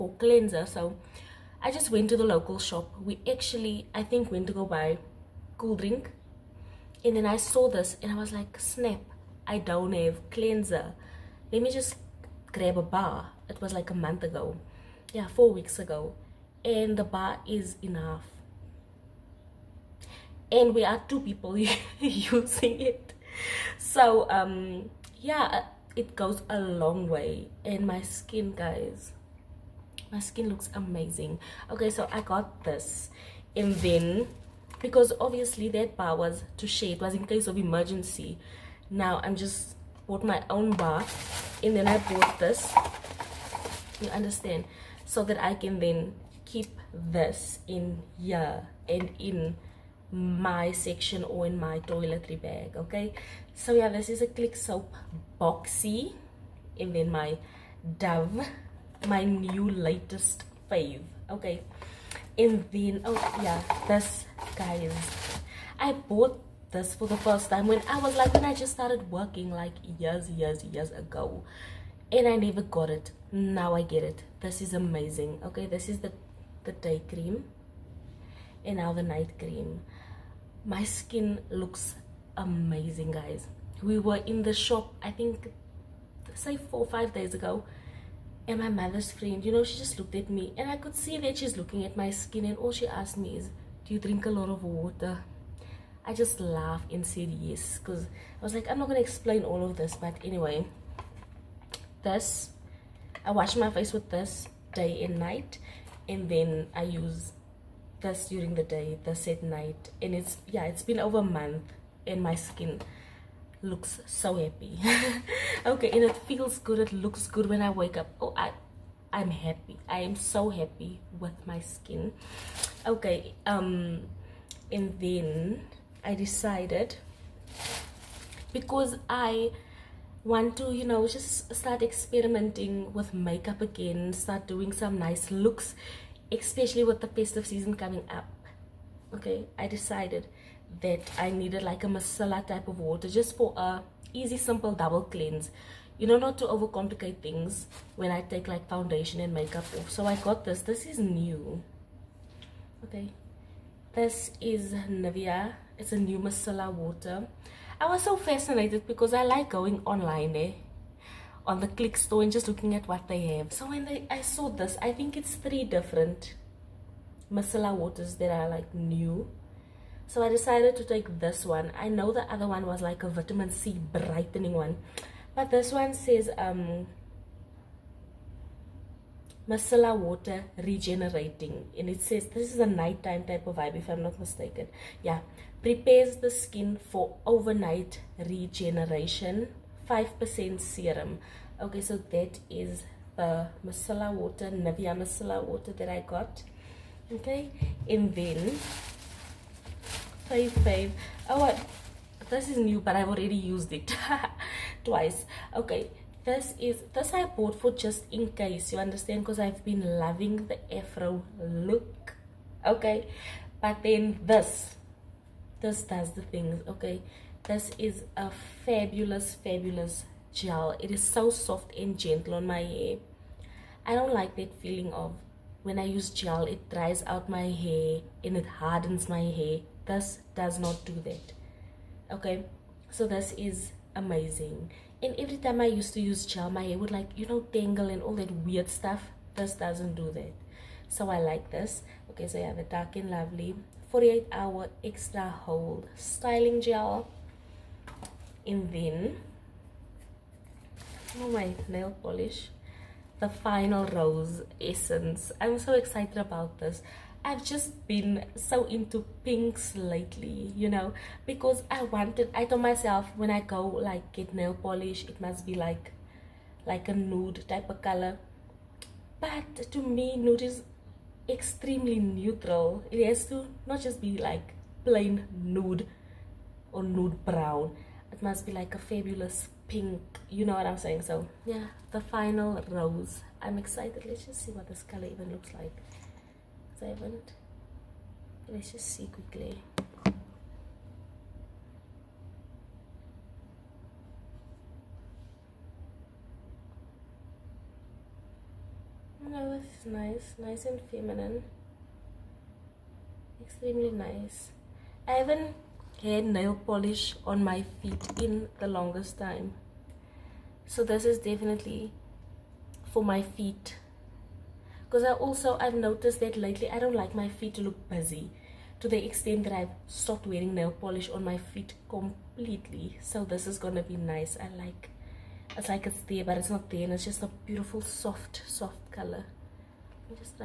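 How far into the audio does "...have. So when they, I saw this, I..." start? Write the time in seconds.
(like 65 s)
163 s.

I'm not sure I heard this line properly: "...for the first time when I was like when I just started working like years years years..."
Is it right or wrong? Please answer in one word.
right.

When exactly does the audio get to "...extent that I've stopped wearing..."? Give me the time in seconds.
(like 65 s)
319 s.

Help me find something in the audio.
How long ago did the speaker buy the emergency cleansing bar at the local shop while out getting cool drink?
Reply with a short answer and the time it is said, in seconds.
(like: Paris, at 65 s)
4 weeks, at 15 s.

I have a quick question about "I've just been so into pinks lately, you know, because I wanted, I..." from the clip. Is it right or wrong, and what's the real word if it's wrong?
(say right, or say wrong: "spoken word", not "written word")
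right.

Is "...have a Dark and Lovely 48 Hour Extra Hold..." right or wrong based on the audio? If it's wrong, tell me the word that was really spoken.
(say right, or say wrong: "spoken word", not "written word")
right.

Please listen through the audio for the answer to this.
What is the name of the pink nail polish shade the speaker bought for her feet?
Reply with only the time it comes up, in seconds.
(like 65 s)
253 s.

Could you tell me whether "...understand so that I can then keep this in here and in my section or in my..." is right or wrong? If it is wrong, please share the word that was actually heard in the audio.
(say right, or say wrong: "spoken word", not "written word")
right.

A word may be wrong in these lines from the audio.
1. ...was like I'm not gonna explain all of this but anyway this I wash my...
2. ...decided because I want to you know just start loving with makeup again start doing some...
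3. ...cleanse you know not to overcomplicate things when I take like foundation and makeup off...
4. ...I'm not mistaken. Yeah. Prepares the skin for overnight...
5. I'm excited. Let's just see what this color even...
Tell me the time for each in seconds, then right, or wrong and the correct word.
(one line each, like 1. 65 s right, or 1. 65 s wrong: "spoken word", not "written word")
1. 98 s right
2. 126 s wrong: "experimenting", not "loving"
3. 145 s right
4. 183 s right
5. 283 s right.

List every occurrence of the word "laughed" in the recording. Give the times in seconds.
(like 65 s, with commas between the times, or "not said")
96 s.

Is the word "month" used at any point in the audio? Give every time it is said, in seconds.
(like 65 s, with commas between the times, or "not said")
13 s, 111 s.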